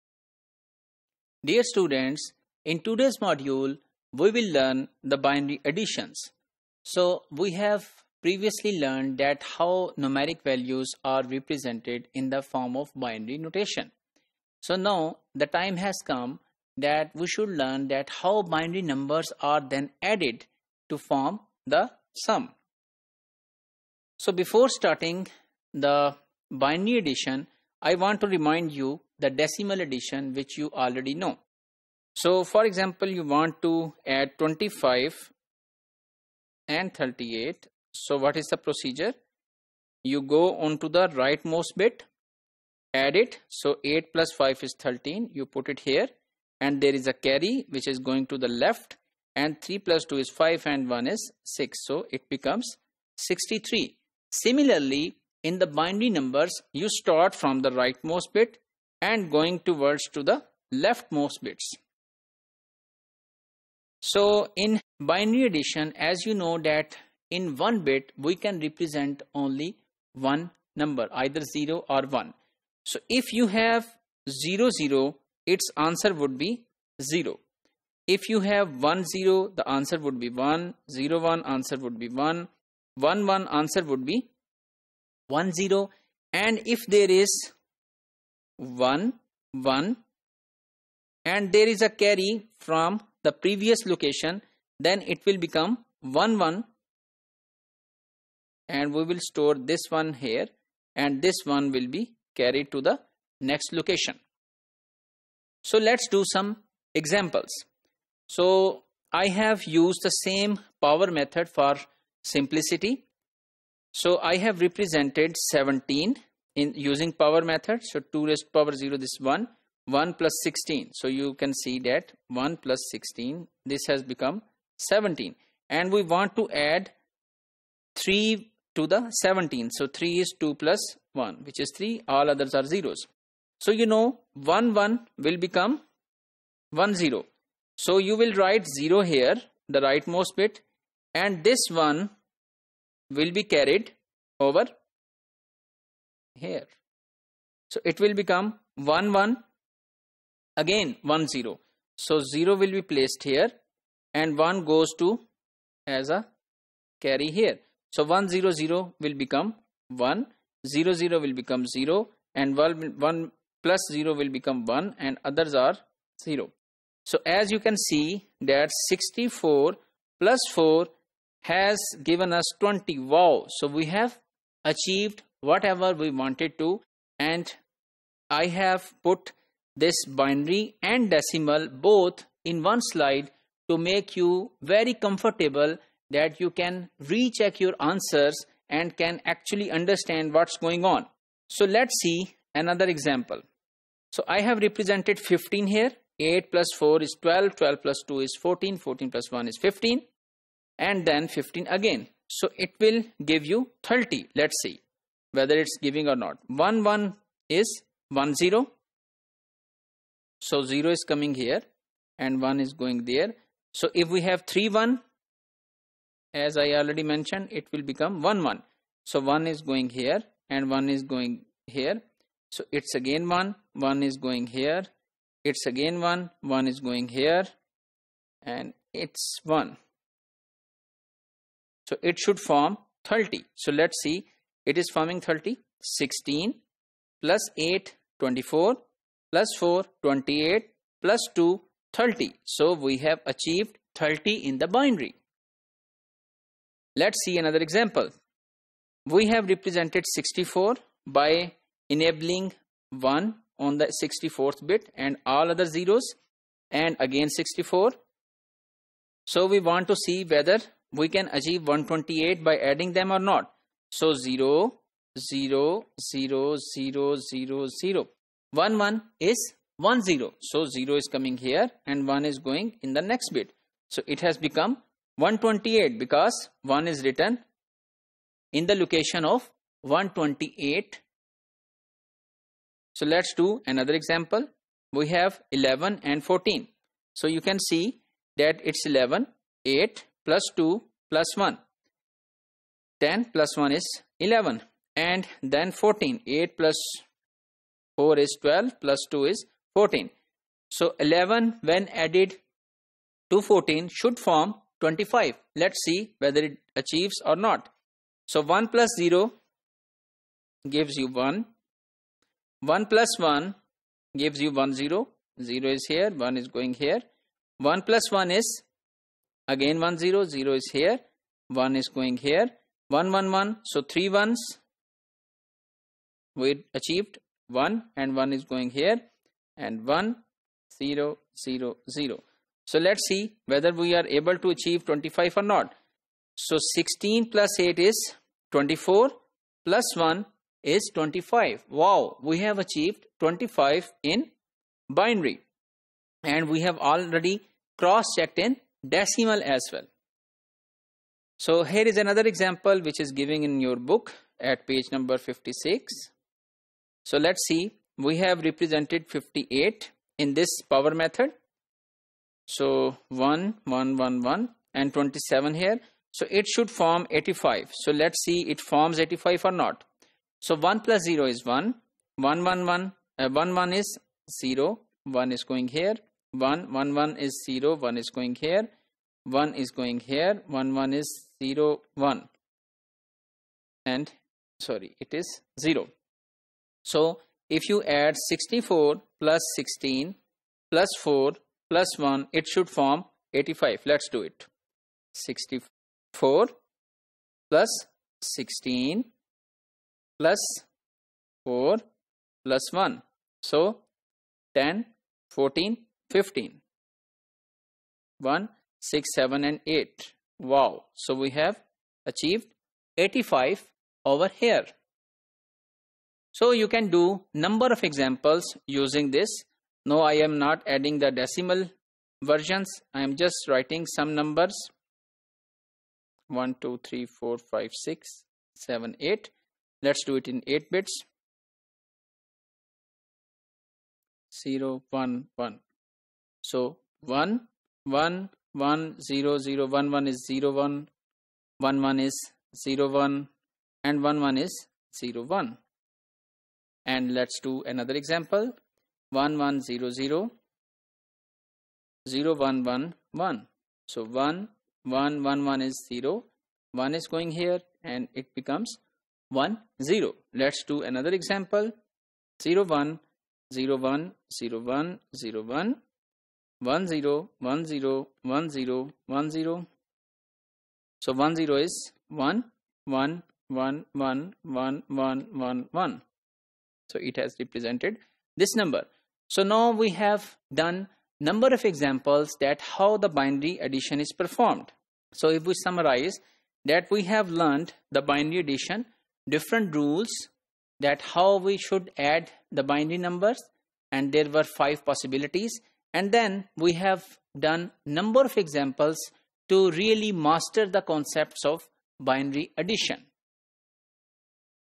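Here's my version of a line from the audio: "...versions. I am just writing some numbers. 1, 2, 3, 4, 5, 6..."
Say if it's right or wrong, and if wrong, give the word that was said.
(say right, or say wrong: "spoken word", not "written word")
right.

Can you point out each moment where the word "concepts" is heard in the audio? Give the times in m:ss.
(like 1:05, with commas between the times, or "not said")
8:20.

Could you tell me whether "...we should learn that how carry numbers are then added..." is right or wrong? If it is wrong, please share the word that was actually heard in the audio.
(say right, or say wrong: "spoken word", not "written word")
wrong: "binary", not "carry".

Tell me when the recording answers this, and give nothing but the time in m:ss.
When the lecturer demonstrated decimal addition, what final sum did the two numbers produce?
0:53.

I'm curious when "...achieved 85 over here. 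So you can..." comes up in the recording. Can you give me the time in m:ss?
6:52.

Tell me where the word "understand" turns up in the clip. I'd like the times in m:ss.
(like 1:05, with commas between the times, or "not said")
3:09.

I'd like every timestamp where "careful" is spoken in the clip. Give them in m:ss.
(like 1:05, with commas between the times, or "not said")
not said.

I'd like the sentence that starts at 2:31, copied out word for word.
So 0 will be placed here and 1 goes to as a carry here.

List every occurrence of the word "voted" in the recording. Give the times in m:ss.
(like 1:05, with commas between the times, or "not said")
not said.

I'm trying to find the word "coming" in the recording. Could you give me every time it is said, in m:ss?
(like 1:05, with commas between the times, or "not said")
3:31, 4:31.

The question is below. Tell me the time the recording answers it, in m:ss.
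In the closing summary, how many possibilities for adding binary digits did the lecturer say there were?
8:14.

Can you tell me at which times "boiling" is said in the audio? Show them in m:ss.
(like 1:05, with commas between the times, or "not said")
not said.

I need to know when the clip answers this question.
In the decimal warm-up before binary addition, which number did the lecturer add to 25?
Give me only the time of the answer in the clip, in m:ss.
0:36.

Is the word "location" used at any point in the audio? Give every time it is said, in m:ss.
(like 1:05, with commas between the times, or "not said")
1:33, 1:43, 4:38.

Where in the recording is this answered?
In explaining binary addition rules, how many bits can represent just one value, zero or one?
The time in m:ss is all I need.
1:07.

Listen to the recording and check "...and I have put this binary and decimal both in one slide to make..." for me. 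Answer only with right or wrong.
right.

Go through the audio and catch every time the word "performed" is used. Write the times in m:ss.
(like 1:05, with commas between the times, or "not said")
8:04.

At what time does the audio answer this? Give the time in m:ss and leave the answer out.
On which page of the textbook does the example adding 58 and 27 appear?
5:55.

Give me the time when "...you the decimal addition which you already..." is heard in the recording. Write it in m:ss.
0:28.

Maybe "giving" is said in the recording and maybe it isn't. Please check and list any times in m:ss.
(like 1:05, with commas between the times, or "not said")
3:25, 5:53.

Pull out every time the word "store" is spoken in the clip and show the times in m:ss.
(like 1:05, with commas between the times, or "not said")
1:39.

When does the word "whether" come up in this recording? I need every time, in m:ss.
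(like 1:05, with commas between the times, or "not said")
3:25, 4:20, 5:06, 5:33.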